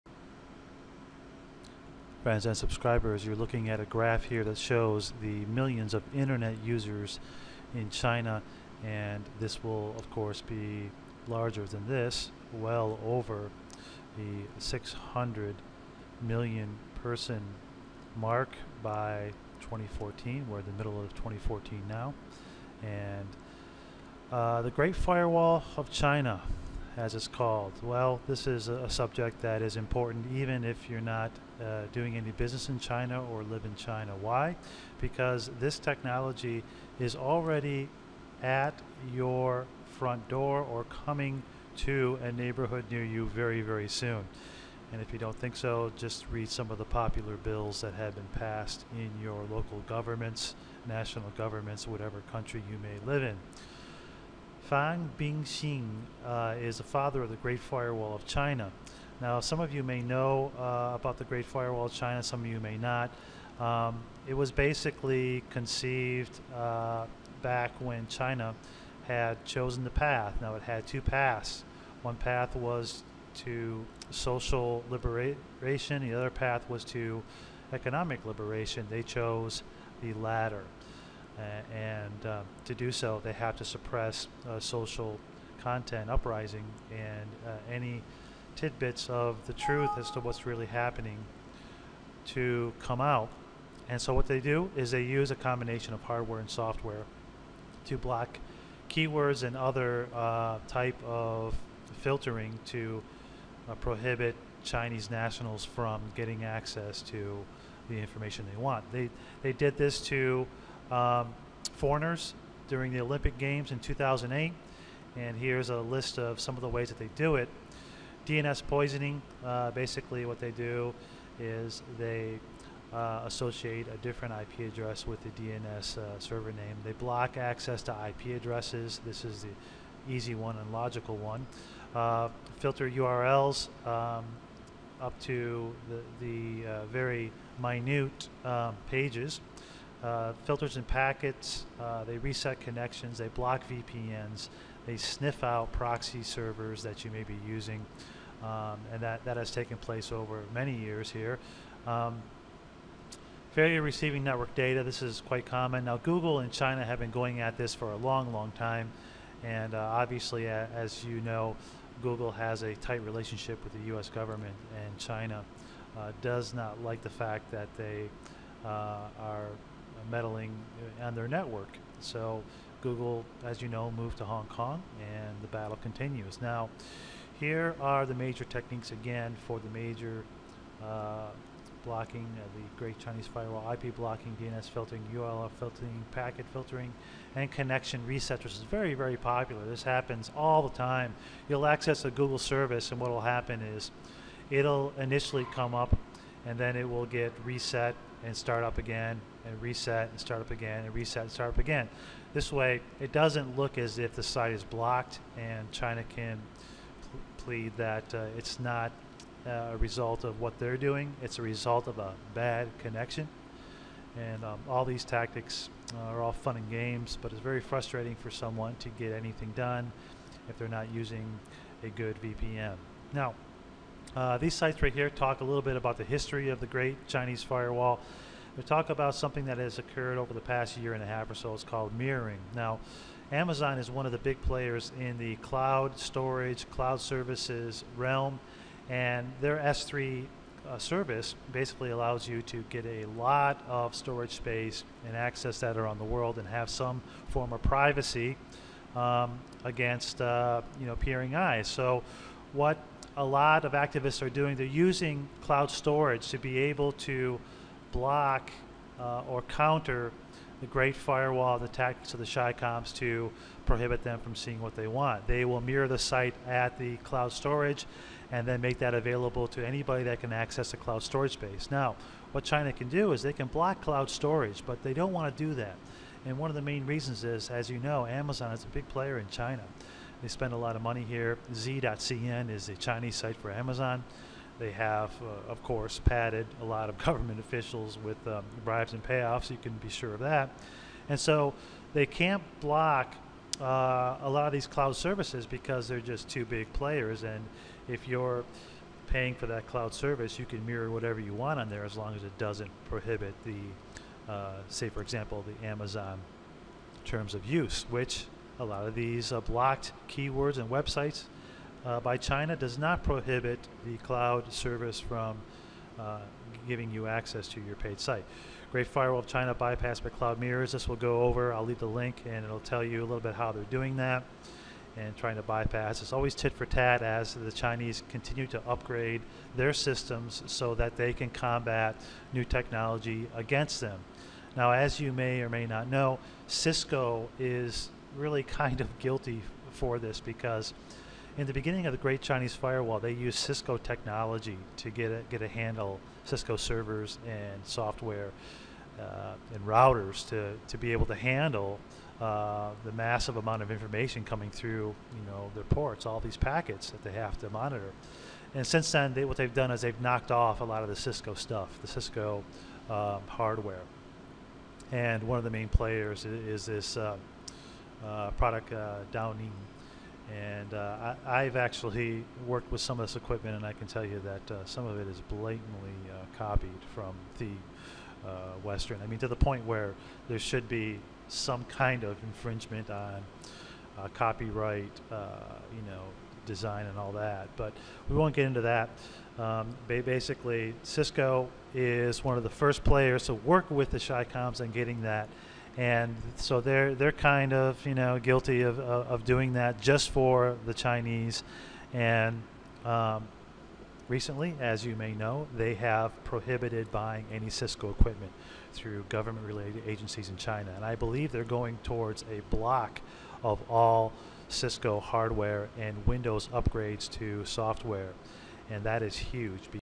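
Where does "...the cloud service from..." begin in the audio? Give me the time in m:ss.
5:13.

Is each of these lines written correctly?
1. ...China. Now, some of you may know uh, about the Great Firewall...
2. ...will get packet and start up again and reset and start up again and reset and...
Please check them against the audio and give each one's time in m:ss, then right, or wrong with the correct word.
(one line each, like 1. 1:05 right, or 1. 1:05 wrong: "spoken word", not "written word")
1. 0:58 right
2. 3:16 wrong: "reset", not "packet".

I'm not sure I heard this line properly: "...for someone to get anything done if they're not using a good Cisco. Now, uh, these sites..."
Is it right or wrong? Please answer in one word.
wrong.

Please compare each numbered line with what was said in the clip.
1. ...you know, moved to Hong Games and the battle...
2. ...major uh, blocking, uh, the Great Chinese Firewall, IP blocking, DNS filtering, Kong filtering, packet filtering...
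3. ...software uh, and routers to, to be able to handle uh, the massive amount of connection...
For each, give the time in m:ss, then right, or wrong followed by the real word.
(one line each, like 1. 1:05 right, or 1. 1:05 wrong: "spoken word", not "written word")
1. 2:53 wrong: "Kong", not "Games"
2. 2:59 wrong: "URL", not "Kong"
3. 5:47 wrong: "information", not "connection".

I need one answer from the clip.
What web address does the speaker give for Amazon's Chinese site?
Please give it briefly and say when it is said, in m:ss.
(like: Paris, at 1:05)
Z.cn, at 4:41.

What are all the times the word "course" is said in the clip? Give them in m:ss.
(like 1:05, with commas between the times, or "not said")
0:10, 4:45.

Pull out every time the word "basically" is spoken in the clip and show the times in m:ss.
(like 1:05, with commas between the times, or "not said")
1:04, 1:59, 4:01, 6:29.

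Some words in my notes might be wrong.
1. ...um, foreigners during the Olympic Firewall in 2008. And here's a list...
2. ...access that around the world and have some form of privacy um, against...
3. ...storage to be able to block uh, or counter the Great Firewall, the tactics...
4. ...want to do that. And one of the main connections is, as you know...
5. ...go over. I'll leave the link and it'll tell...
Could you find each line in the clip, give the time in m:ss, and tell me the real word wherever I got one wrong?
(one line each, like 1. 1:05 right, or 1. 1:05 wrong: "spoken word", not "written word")
1. 1:50 wrong: "Games", not "Firewall"
2. 4:05 right
3. 4:15 right
4. 4:35 wrong: "reasons", not "connections"
5. 5:20 right.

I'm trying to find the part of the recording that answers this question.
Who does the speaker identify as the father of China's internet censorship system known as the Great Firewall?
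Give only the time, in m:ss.
0:54.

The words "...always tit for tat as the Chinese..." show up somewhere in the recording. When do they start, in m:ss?
5:26.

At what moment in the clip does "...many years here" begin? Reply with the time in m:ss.
2:30.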